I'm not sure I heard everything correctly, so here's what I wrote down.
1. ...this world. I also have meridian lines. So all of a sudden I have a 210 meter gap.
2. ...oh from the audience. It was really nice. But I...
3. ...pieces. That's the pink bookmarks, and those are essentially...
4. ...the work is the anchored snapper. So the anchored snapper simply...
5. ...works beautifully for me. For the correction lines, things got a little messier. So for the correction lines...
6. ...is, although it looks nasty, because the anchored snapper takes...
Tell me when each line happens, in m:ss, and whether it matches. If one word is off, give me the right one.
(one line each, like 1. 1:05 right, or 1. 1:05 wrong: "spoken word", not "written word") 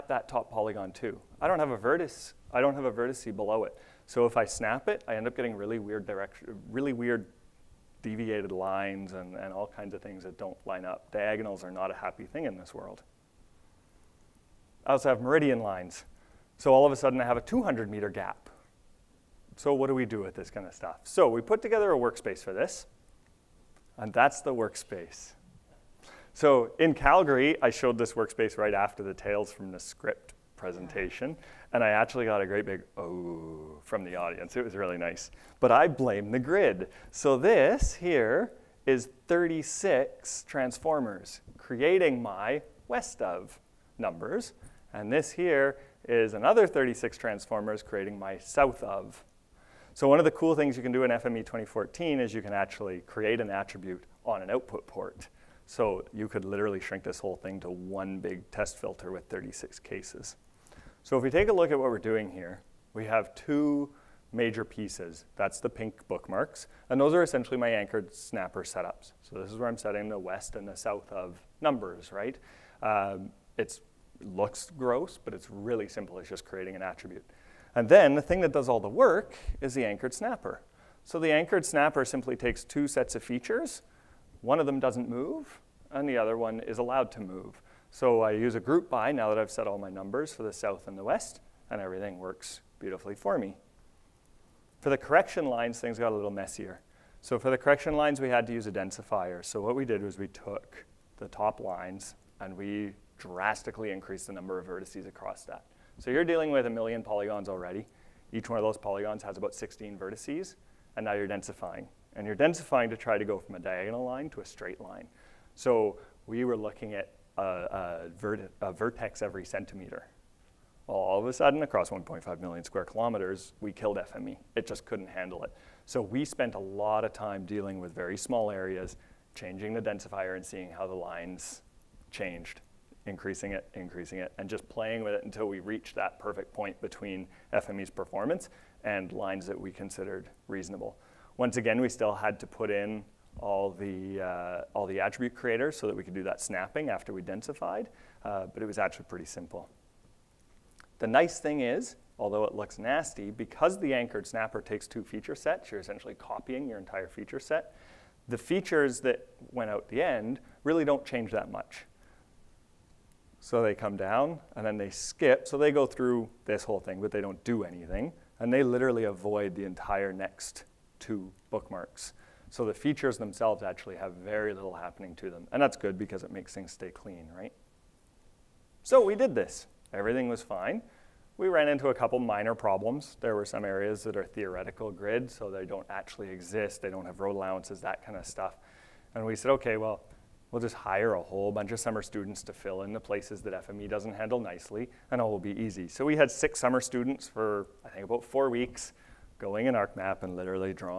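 1. 0:12 wrong: "200", not "210"
2. 0:32 right
3. 1:04 right
4. 1:18 right
5. 1:32 right
6. 2:31 right.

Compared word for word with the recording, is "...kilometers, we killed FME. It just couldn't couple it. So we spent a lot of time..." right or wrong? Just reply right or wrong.
wrong.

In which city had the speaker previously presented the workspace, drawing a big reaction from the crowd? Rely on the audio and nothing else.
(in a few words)
Calgary.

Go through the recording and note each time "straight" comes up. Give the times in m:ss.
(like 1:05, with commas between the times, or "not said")
1:54.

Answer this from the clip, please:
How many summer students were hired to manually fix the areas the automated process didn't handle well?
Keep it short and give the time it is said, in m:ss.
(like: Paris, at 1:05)
6, at 3:16.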